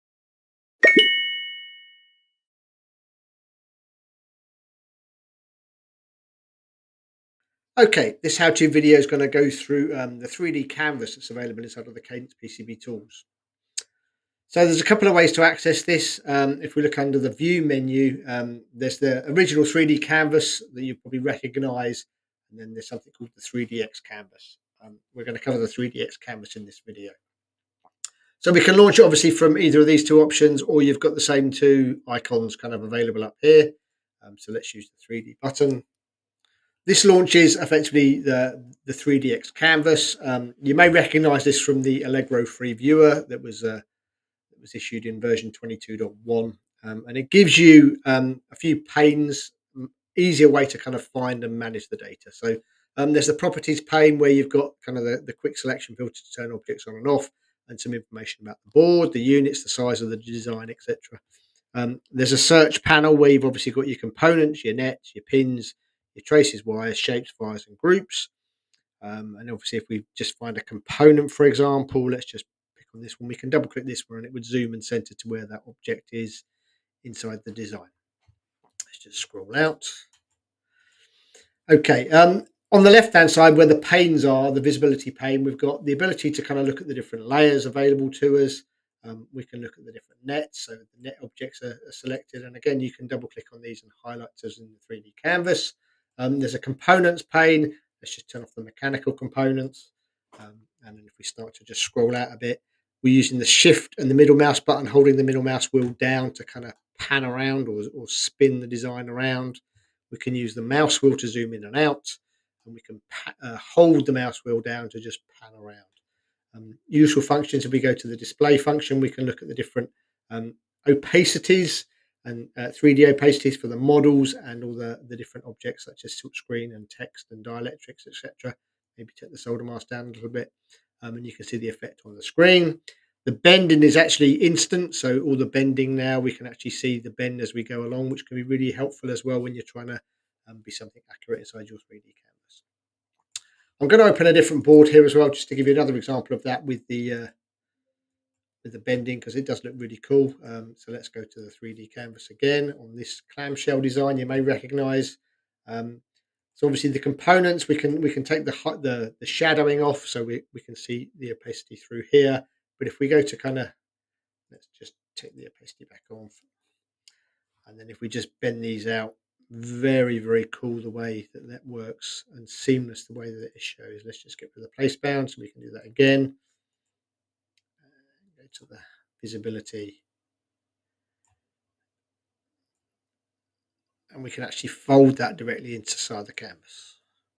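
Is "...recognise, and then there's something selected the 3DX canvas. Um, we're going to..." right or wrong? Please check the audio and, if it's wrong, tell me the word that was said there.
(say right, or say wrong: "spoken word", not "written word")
wrong: "called", not "selected".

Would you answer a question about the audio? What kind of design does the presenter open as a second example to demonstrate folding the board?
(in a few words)
clamshell design.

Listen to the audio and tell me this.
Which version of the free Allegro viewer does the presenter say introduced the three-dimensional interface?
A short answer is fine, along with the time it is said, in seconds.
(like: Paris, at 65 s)
22.1, at 45 s.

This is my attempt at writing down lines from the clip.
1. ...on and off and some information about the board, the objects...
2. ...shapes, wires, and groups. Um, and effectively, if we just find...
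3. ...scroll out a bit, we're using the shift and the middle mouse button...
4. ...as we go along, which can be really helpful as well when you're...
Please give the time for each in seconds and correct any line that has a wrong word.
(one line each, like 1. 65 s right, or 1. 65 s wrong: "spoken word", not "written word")
1. 56 s wrong: "units", not "objects"
2. 66 s wrong: "obviously", not "effectively"
3. 101 s right
4. 137 s right.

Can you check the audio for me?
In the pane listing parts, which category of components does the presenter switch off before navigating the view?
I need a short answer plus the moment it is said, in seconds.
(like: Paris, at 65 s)
mechanical, at 98 s.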